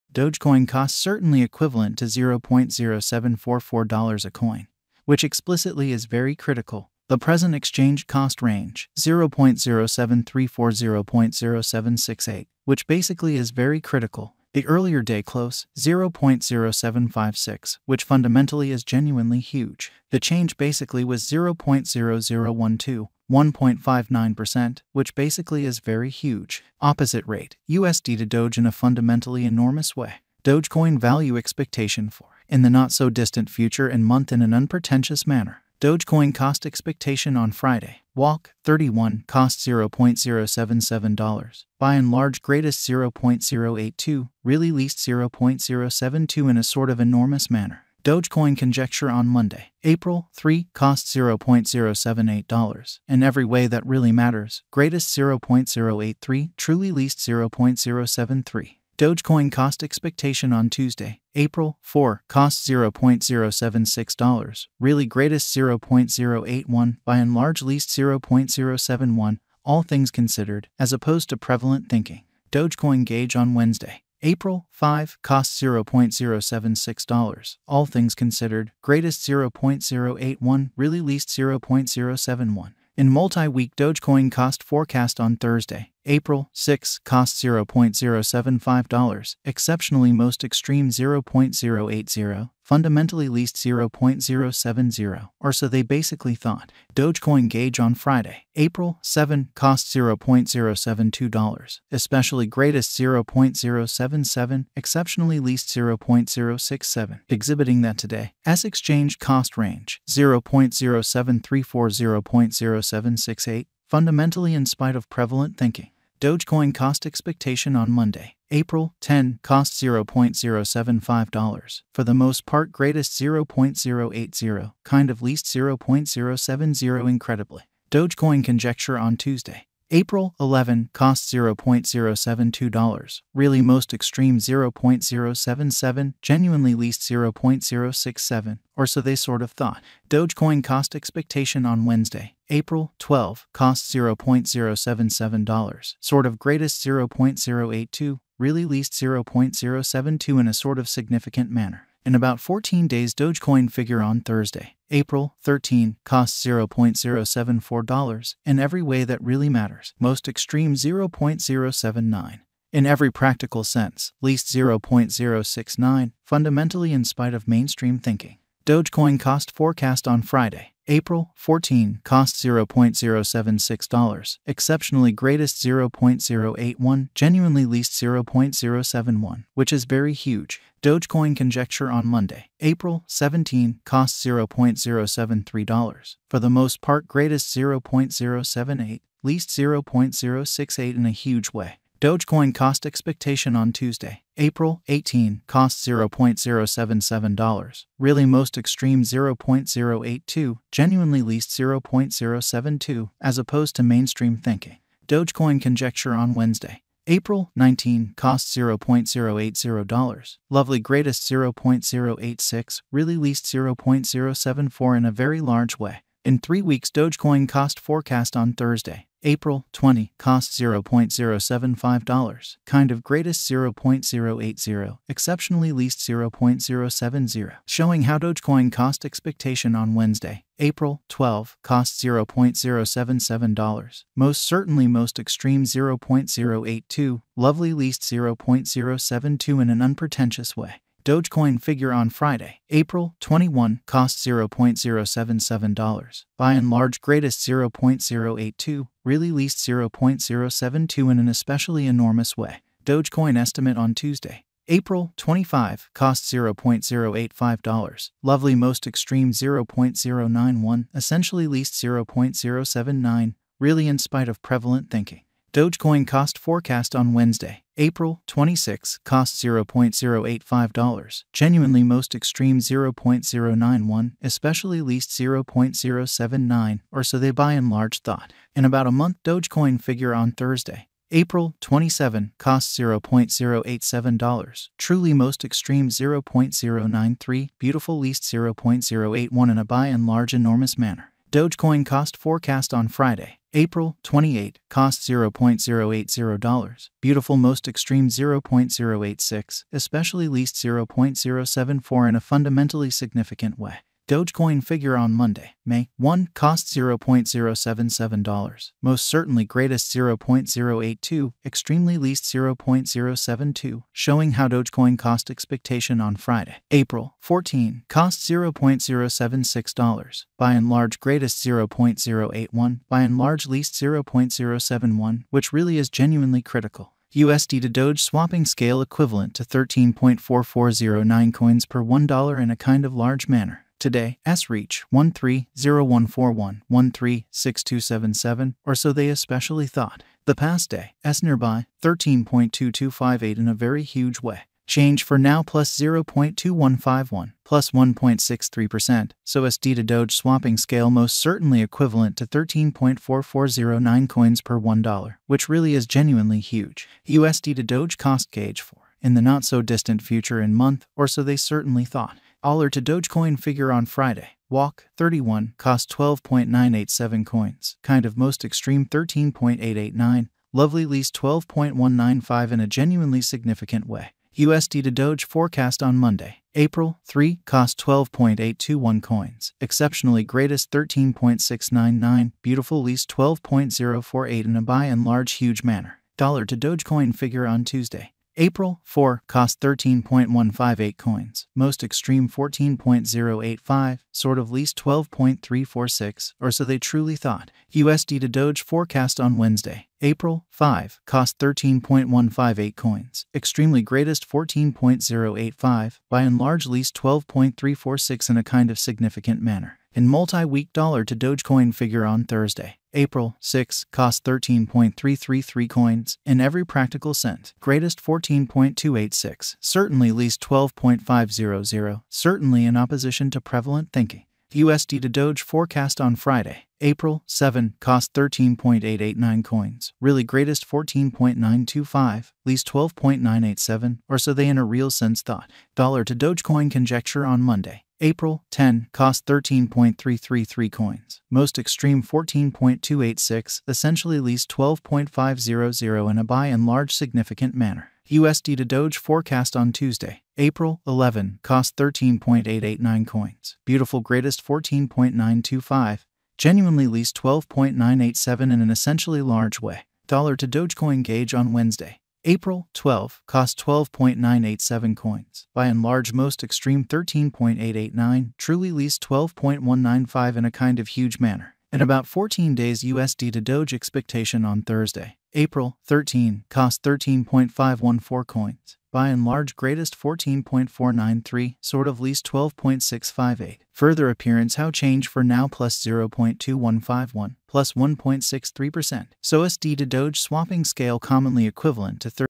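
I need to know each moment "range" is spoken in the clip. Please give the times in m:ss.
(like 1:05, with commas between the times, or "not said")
0:08, 1:49.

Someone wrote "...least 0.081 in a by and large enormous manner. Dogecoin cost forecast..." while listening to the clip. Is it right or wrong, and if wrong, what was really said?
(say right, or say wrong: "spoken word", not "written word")
right.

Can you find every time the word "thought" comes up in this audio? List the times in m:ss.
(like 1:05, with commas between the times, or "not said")
1:36, 2:19, 4:38, 5:39, 6:01, 6:37, 7:15.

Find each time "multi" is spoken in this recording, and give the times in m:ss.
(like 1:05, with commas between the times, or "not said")
1:23, 6:50.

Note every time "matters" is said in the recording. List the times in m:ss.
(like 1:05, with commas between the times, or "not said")
0:54, 2:39.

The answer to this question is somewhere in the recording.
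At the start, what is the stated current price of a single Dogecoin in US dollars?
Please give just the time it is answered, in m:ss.
0:02.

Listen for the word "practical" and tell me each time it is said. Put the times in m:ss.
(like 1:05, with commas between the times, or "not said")
2:43, 6:56.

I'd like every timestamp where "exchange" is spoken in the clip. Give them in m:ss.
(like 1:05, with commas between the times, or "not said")
0:07, 1:48.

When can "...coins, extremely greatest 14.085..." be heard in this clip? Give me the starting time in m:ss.
6:42.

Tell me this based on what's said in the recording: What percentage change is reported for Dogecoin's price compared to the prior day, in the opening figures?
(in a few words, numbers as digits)
1.59%.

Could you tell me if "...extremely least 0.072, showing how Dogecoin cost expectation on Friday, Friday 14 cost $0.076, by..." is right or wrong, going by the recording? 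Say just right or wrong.
wrong.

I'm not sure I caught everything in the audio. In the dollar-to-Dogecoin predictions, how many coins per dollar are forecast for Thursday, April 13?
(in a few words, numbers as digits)
13.514.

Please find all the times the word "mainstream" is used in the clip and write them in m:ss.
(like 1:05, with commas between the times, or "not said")
2:47, 3:23.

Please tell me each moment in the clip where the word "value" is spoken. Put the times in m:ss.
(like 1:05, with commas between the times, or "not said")
0:30.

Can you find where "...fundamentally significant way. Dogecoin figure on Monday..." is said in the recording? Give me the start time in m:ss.
5:02.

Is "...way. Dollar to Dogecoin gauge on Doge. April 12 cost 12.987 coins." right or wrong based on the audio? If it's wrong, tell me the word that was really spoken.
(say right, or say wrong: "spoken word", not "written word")
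wrong: "Wednesday", not "Doge".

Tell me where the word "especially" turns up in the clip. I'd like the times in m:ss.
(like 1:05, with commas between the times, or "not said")
1:41, 4:11, 4:34, 4:59, 5:39.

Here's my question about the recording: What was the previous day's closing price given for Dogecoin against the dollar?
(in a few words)
0.0756.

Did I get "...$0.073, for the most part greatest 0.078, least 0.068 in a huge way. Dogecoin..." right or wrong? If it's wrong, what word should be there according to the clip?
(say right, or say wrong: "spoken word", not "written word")
right.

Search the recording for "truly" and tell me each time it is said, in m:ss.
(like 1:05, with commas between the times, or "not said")
0:56, 4:44, 6:36, 7:48.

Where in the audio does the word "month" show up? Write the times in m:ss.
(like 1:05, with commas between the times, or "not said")
0:34, 4:38, 6:00.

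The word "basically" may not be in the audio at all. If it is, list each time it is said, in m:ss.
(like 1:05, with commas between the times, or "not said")
0:12, 0:20, 0:25, 1:35.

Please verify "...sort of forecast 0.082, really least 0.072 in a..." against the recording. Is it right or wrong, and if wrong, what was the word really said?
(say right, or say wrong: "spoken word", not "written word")
wrong: "greatest", not "forecast".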